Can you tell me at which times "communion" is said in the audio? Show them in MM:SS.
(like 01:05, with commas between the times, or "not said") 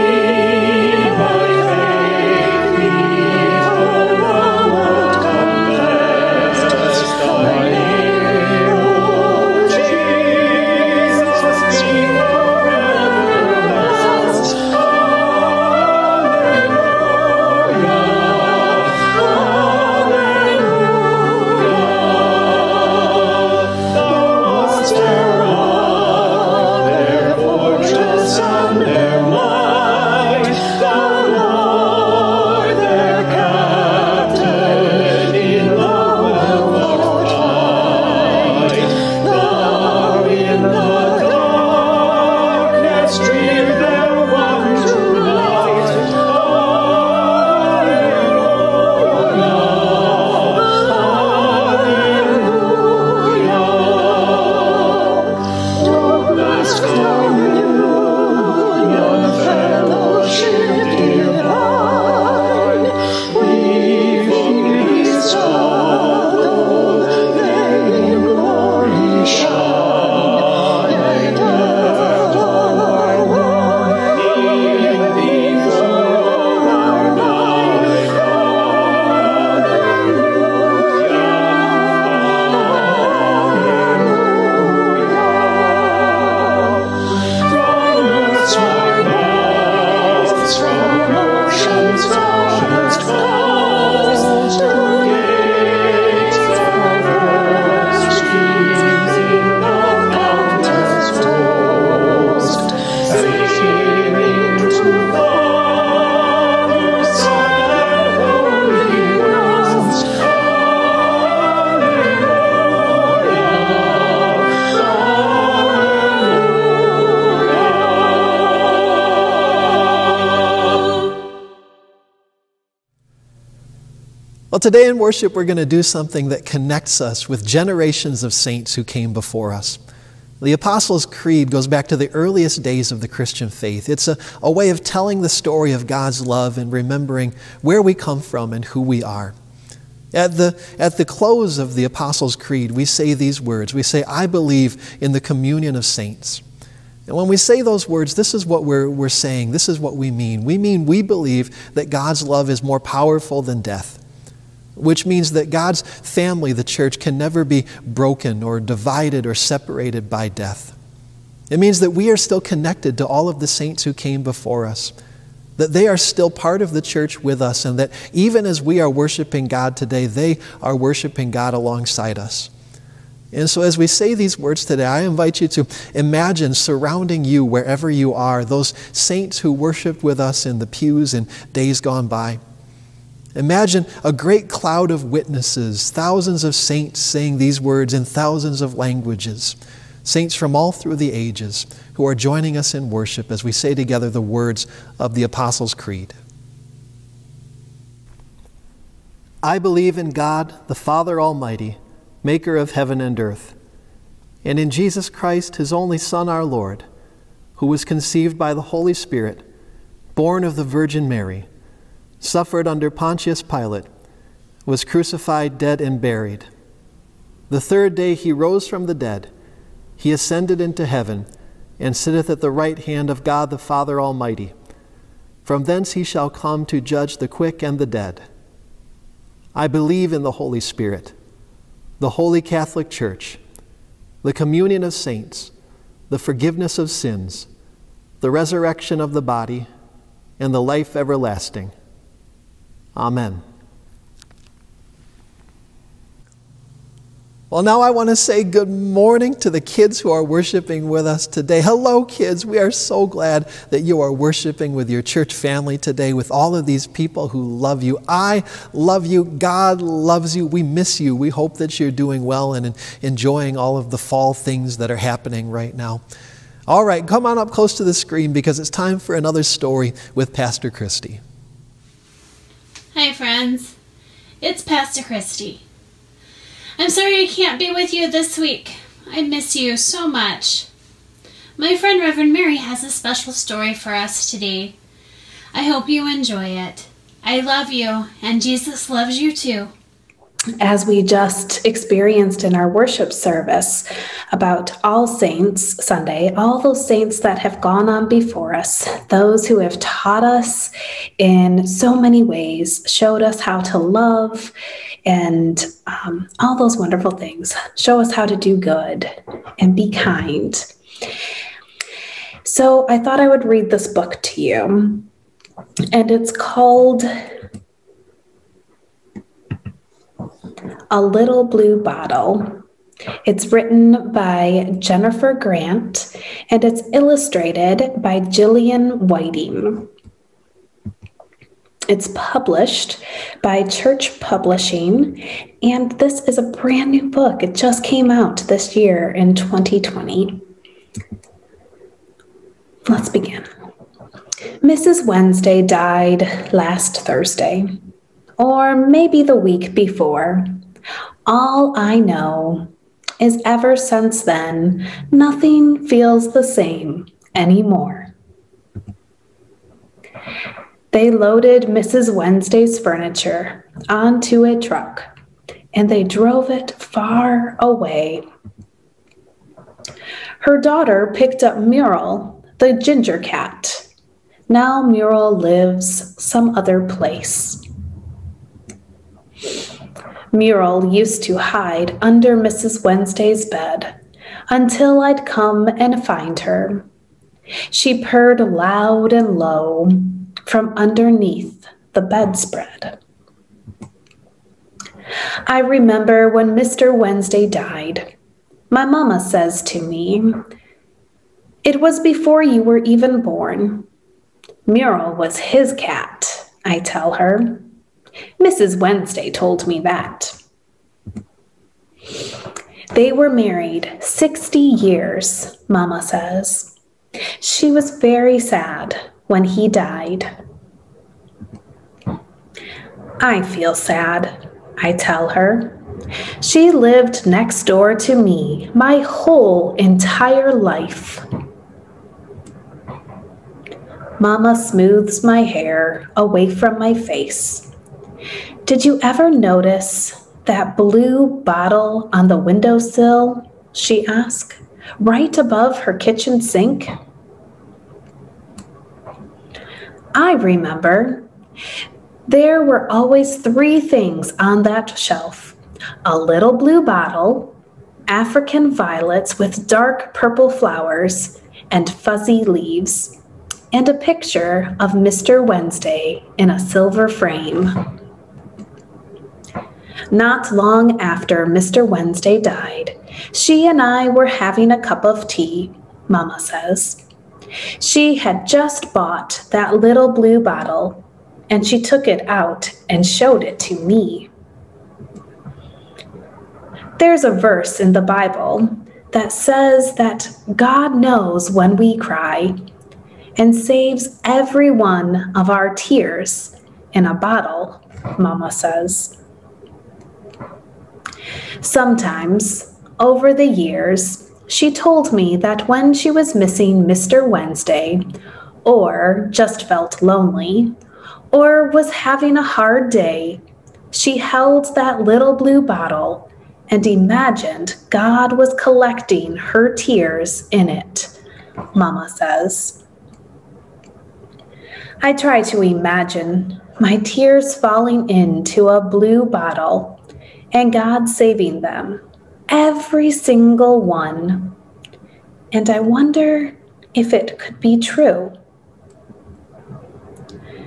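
02:25, 03:54.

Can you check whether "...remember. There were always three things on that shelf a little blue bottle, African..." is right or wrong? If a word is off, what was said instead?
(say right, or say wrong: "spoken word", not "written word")
right.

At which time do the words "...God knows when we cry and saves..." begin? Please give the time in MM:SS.
08:10.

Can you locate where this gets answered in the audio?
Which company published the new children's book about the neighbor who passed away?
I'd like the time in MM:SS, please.
05:33.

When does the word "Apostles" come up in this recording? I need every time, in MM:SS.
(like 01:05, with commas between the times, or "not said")
02:10, 02:21, 03:15.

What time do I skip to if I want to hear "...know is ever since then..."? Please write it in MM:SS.
05:51.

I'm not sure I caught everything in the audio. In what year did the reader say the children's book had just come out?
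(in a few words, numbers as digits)
2020.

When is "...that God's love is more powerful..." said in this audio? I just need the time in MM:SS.
02:31.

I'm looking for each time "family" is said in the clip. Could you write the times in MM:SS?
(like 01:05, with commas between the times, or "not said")
02:35, 04:15.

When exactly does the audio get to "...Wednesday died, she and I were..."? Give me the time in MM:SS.
07:51.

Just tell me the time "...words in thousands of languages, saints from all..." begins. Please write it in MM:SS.
03:07.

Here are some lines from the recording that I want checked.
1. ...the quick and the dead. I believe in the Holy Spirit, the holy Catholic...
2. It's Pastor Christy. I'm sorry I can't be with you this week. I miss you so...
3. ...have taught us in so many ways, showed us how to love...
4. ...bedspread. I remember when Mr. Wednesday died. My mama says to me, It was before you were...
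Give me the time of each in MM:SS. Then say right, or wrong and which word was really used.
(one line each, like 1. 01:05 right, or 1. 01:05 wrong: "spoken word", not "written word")
1. 03:47 right
2. 04:34 right
3. 04:59 right
4. 06:32 right.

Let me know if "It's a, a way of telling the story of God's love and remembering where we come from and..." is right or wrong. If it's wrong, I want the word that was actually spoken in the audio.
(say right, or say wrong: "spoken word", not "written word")
right.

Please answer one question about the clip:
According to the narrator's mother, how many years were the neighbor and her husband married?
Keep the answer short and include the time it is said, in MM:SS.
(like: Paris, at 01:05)
60, at 06:53.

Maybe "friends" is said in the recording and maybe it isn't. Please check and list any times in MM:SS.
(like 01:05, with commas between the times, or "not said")
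04:33, 04:41.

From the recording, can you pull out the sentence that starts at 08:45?
I try to imagine my tears falling into a blue bottle and God saving them, every single one.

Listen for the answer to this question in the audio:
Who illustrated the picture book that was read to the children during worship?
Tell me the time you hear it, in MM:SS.
05:28.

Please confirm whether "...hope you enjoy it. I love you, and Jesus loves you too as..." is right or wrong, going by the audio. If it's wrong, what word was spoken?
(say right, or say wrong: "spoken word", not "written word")
right.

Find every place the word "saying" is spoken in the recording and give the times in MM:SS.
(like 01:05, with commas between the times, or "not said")
02:29, 03:06.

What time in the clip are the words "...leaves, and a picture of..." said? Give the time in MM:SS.
07:42.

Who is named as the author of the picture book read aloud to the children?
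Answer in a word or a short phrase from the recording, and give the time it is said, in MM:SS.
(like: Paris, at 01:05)
Jennifer Grant, at 05:24.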